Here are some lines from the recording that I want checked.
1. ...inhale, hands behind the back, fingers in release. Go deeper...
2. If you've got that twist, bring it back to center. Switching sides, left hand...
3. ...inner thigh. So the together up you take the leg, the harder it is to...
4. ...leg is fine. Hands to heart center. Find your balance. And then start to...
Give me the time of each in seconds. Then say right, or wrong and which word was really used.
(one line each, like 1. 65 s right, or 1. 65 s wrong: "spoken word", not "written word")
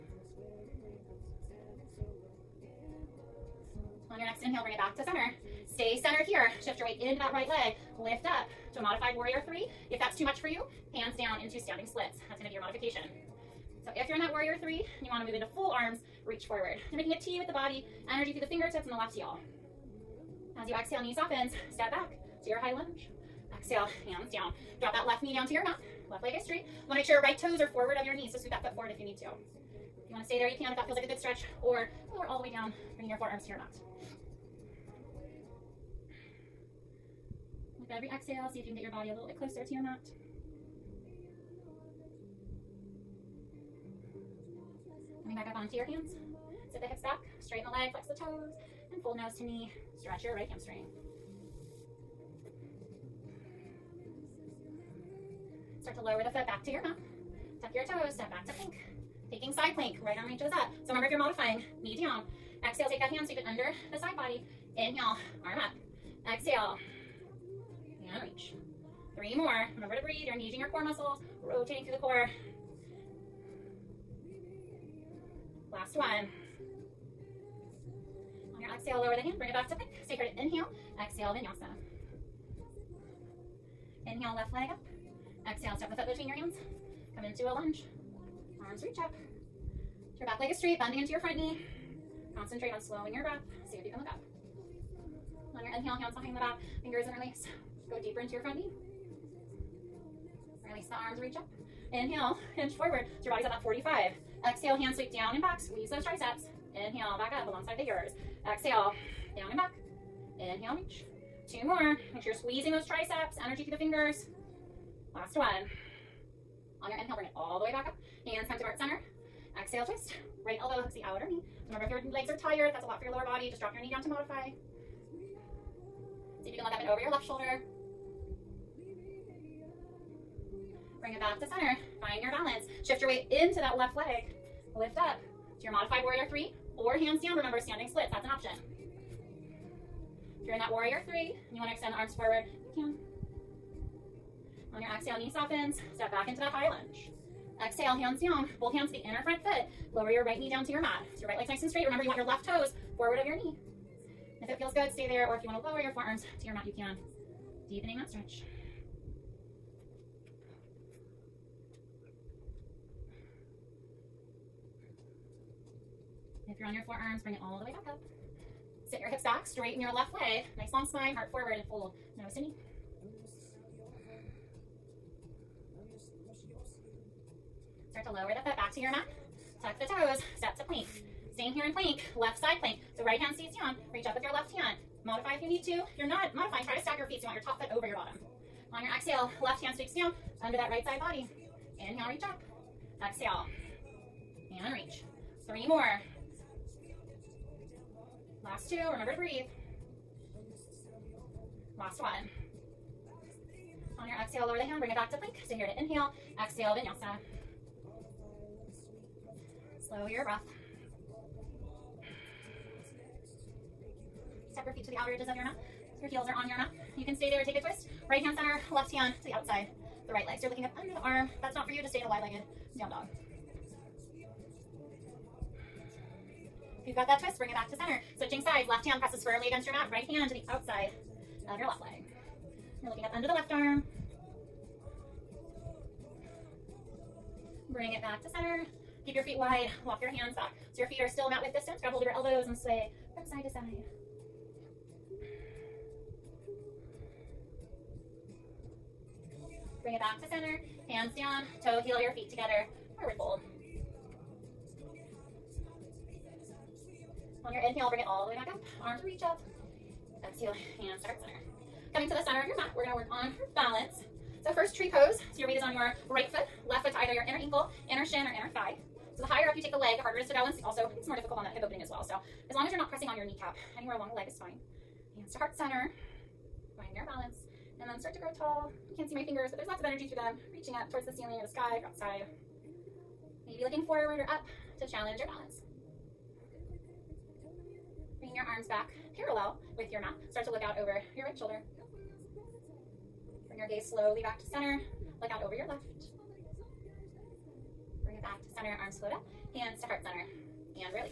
1. 95 s right
2. 226 s right
3. 268 s wrong: "higher", not "together"
4. 274 s right.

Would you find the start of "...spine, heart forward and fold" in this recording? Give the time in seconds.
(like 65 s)
170 s.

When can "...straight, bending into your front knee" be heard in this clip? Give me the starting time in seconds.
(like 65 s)
90 s.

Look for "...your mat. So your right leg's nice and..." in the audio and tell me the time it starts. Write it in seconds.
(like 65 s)
150 s.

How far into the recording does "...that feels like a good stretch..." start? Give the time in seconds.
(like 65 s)
30 s.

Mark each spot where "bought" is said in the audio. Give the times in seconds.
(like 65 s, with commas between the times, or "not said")
not said.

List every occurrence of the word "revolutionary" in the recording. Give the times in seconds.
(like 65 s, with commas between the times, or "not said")
not said.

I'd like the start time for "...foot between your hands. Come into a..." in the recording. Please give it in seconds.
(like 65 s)
85 s.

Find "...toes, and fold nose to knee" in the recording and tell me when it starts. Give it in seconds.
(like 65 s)
48 s.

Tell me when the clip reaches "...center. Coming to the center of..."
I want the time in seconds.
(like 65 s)
261 s.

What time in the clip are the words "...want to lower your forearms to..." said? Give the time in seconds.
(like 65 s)
155 s.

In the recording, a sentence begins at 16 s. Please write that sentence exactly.
You're making a T with the body, energy through the fingertips and the left heel.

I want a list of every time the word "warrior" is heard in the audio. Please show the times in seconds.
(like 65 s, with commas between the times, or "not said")
9 s, 14 s, 136 s, 140 s.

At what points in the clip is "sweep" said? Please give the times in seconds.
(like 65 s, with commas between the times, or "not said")
63 s, 104 s, 189 s.